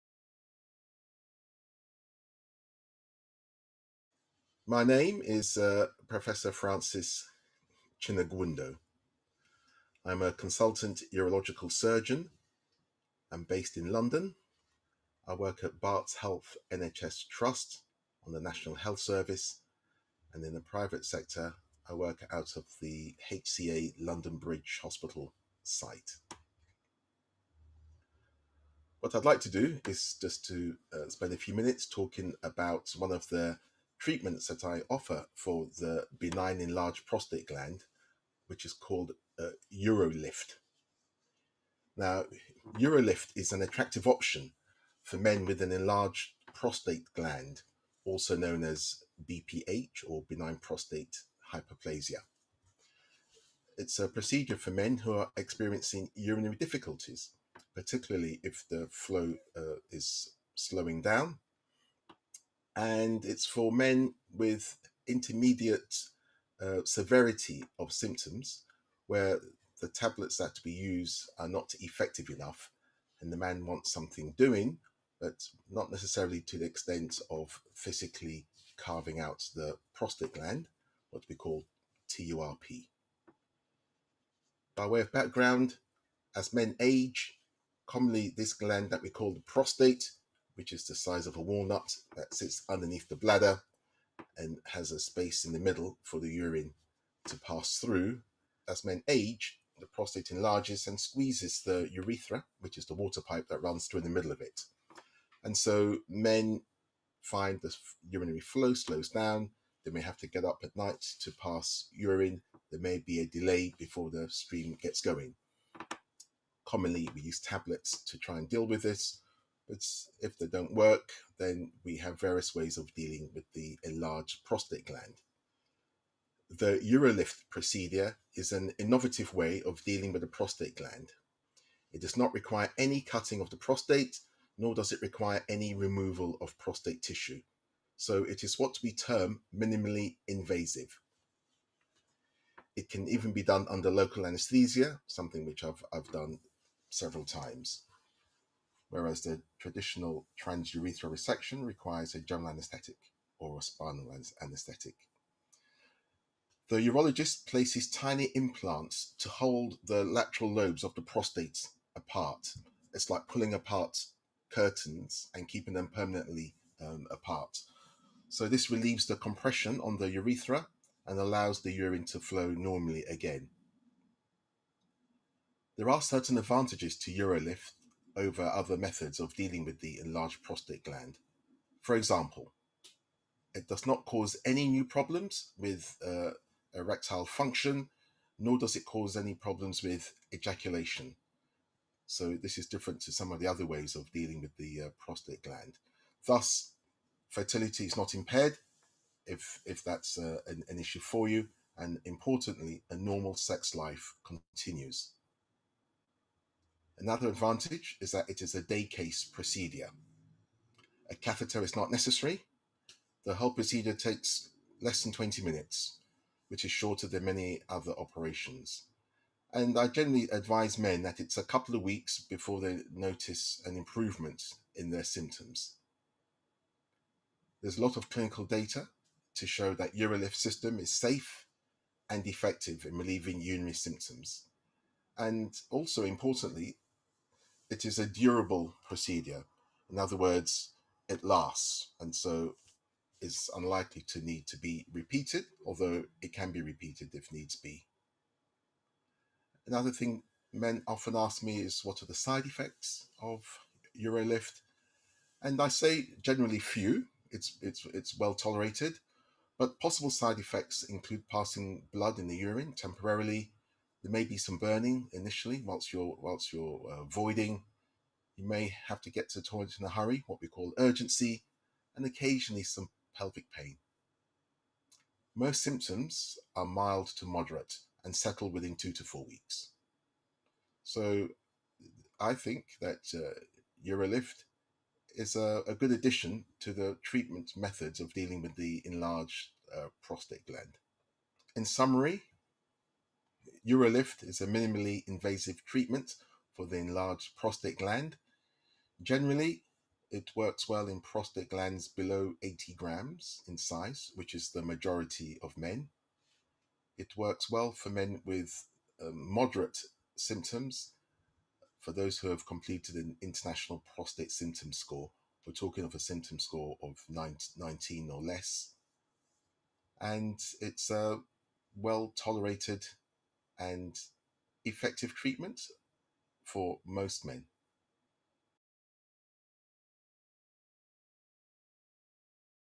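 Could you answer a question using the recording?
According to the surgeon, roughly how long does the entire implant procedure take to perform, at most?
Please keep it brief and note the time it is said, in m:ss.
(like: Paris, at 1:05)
20 minutes, at 3:35.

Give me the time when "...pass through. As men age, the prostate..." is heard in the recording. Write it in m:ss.
1:37.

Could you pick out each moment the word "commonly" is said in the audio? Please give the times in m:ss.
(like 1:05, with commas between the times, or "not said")
1:27, 1:56.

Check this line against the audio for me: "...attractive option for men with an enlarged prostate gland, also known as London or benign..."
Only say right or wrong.
wrong.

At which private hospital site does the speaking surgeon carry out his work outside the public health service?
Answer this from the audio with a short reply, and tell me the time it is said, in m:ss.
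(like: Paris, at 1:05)
HCA London Bridge Hospital, at 0:23.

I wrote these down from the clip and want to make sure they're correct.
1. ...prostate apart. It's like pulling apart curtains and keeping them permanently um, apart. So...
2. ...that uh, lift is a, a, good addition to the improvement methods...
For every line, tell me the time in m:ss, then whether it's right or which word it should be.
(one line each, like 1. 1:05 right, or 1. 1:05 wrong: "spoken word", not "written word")
1. 2:41 right
2. 4:42 wrong: "treatment", not "improvement".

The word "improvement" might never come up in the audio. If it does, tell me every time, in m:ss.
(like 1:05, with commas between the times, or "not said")
3:43.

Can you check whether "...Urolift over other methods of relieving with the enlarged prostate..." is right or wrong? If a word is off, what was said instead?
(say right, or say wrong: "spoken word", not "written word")
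wrong: "dealing", not "relieving".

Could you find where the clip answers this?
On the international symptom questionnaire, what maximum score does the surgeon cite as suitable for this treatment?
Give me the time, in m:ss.
5:17.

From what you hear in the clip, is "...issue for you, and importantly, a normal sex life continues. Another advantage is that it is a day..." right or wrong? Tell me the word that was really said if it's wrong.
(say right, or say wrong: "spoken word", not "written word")
right.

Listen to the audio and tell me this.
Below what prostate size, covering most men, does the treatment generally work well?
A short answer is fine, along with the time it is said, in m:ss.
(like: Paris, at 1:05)
80 grams, at 5:02.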